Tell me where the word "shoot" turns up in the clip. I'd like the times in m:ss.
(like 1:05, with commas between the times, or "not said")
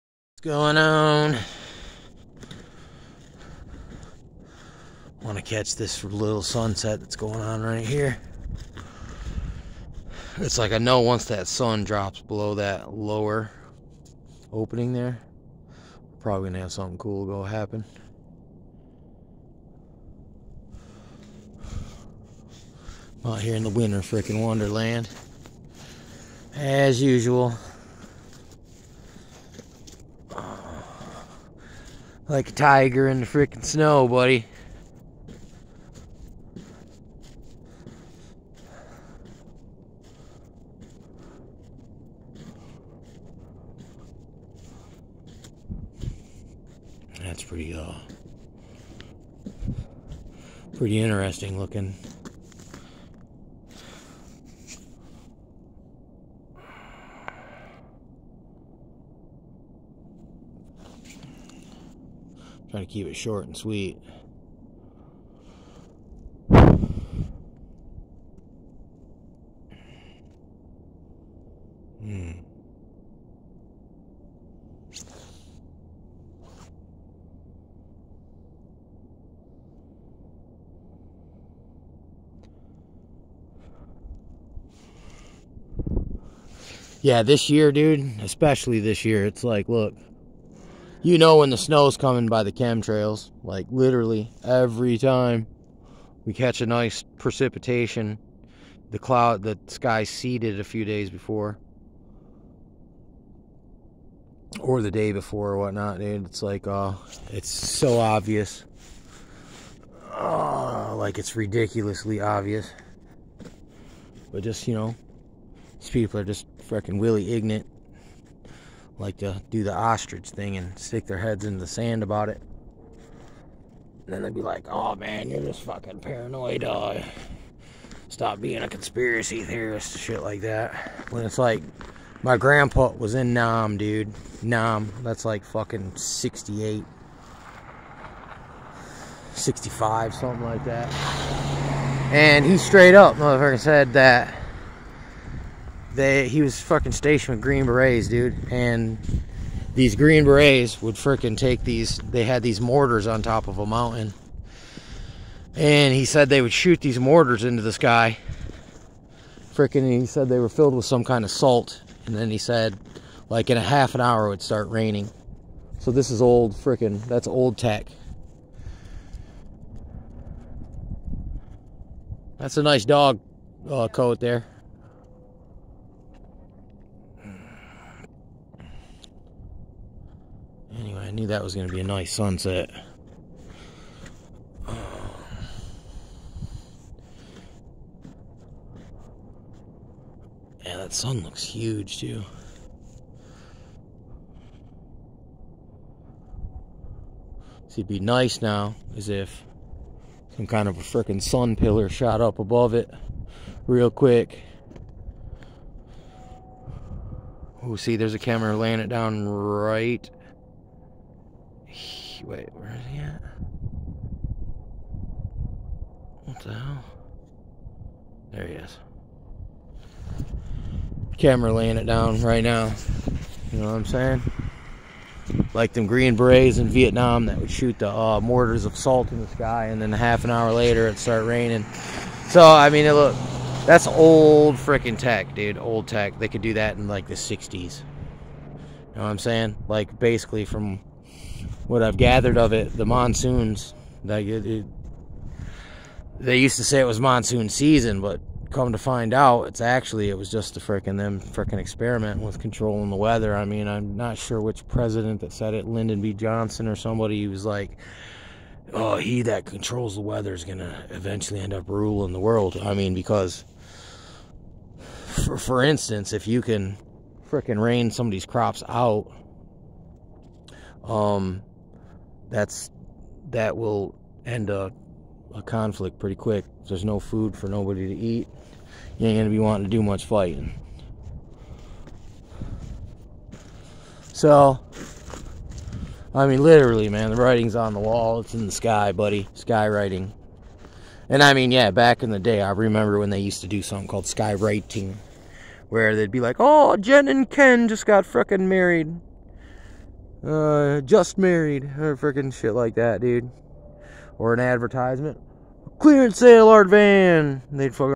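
2:36, 3:47.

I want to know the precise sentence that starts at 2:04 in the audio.
And then they'd be like, oh man, you're just fucking paranoid.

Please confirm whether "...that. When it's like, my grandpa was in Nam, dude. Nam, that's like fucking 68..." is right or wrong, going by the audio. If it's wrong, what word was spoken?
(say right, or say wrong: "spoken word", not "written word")
right.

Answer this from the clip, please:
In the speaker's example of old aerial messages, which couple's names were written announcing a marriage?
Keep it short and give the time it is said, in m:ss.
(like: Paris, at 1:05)
Jen and Ken, at 4:56.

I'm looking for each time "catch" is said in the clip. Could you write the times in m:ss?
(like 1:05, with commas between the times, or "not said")
0:05, 1:36.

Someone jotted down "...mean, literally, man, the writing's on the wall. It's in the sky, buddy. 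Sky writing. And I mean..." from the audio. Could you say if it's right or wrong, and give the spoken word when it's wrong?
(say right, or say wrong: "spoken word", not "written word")
right.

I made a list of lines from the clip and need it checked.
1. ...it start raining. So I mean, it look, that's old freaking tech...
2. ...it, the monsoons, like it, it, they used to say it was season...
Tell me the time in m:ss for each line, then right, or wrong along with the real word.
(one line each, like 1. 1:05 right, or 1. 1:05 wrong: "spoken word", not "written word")
1. 3:50 right
2. 4:02 wrong: "monsoon", not "season".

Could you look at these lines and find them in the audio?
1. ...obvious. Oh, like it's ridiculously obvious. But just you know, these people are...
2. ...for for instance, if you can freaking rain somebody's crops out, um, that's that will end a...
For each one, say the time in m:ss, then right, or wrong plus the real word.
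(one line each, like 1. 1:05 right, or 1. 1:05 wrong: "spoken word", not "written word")
1. 1:47 right
2. 4:25 right.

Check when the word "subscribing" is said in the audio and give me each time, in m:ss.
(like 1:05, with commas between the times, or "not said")
not said.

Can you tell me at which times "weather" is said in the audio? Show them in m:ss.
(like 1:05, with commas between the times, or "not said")
4:12, 4:20.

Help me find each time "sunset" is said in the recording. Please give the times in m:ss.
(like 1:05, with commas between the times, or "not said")
0:06, 3:02.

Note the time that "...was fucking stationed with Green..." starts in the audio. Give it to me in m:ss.
2:26.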